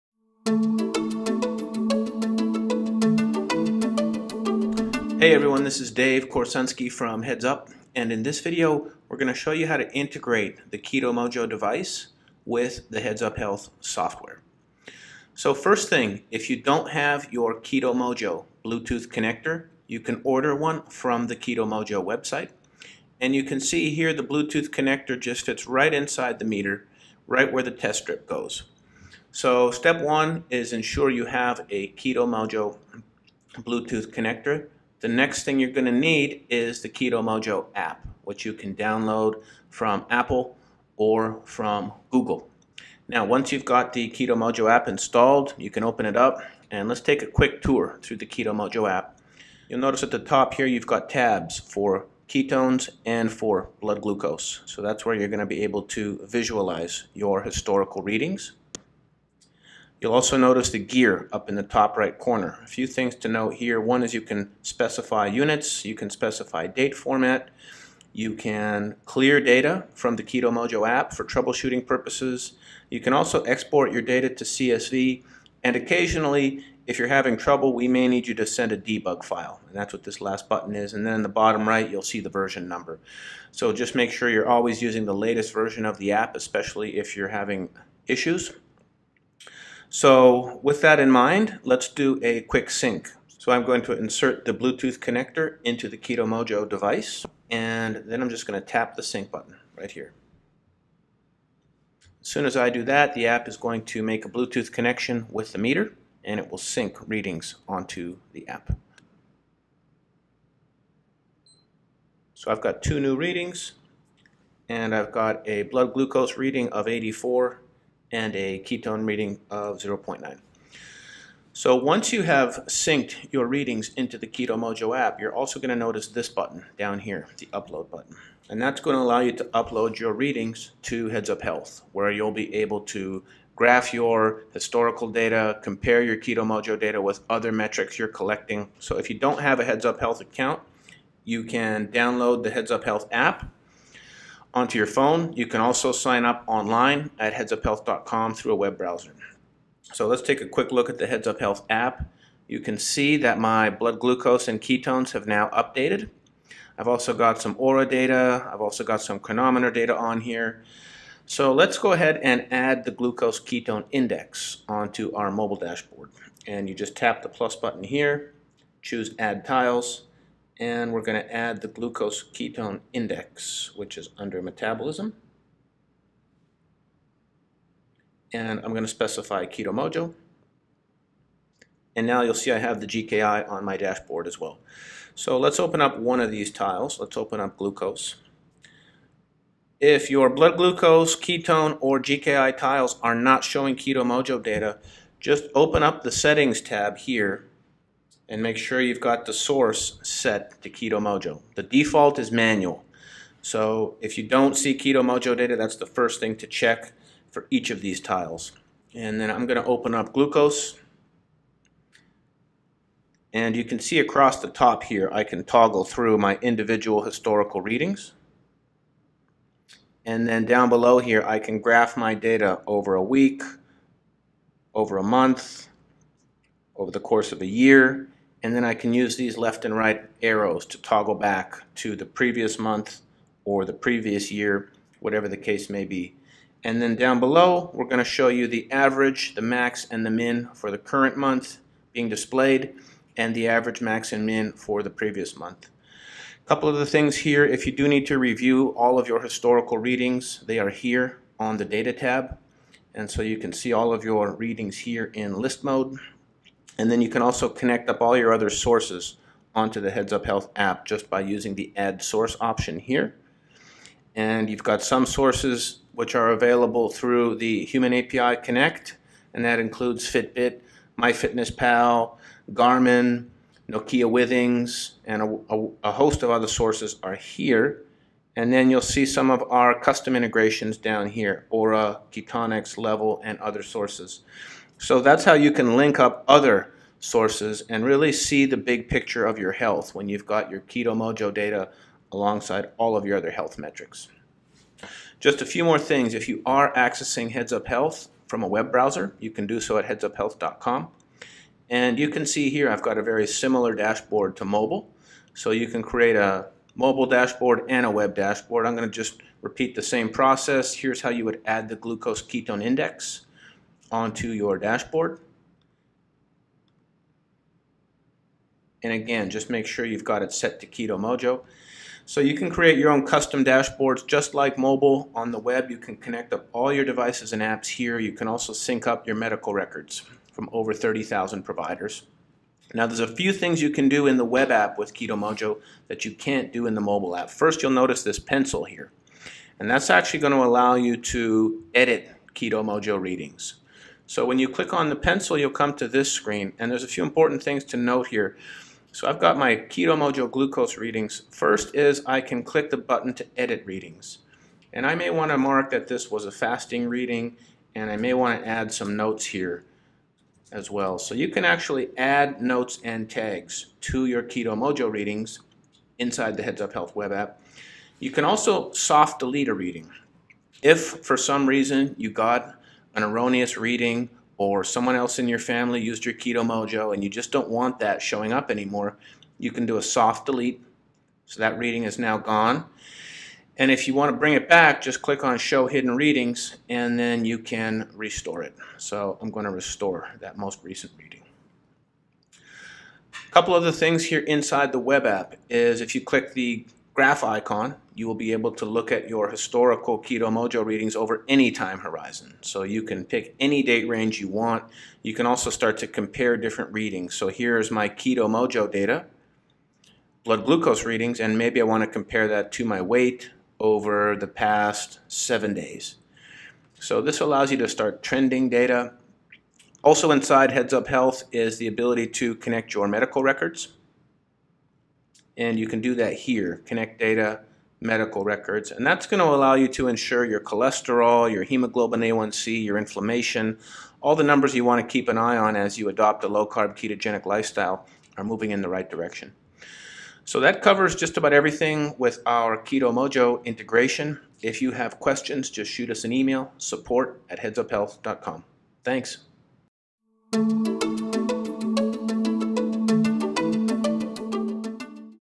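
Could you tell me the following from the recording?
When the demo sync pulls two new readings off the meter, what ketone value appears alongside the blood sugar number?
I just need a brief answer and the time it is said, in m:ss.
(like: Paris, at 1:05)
0.9, at 1:59.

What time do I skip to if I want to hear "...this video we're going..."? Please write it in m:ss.
0:08.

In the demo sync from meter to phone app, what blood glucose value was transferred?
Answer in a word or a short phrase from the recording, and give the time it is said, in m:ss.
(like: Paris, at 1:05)
84, at 1:56.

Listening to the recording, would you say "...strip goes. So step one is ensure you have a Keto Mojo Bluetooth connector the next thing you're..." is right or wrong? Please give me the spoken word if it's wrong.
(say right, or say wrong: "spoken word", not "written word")
right.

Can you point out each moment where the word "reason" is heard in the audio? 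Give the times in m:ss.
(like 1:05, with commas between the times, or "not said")
6:11.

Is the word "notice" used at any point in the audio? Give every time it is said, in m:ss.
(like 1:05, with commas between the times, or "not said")
0:49, 1:00, 2:05, 5:37.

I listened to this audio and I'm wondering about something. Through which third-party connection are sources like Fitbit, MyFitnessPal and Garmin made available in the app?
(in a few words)
Human API Connect.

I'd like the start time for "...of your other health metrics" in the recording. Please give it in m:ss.
4:52.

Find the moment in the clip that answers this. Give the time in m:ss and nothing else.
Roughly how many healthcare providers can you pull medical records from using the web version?
5:30.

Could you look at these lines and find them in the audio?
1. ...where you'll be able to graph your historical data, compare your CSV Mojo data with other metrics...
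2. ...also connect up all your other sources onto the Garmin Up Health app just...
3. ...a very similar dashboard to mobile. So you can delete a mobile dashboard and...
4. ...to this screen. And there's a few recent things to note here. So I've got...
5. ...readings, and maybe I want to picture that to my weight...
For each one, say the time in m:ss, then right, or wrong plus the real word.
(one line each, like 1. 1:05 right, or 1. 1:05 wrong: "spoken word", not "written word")
1. 2:11 wrong: "Keto", not "CSV"
2. 4:17 wrong: "Heads", not "Garmin"
3. 5:02 wrong: "create", not "delete"
4. 5:45 wrong: "important", not "recent"
5. 6:50 wrong: "compare", not "picture".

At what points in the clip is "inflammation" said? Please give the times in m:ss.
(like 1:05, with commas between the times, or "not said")
7:12.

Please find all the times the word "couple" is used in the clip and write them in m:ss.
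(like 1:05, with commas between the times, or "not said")
4:06, 6:33.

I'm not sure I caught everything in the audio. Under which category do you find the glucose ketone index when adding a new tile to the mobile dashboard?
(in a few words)
metabolism.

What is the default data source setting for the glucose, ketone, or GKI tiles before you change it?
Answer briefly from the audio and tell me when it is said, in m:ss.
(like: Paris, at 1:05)
manual, at 3:22.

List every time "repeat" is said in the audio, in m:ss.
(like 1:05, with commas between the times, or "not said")
5:09.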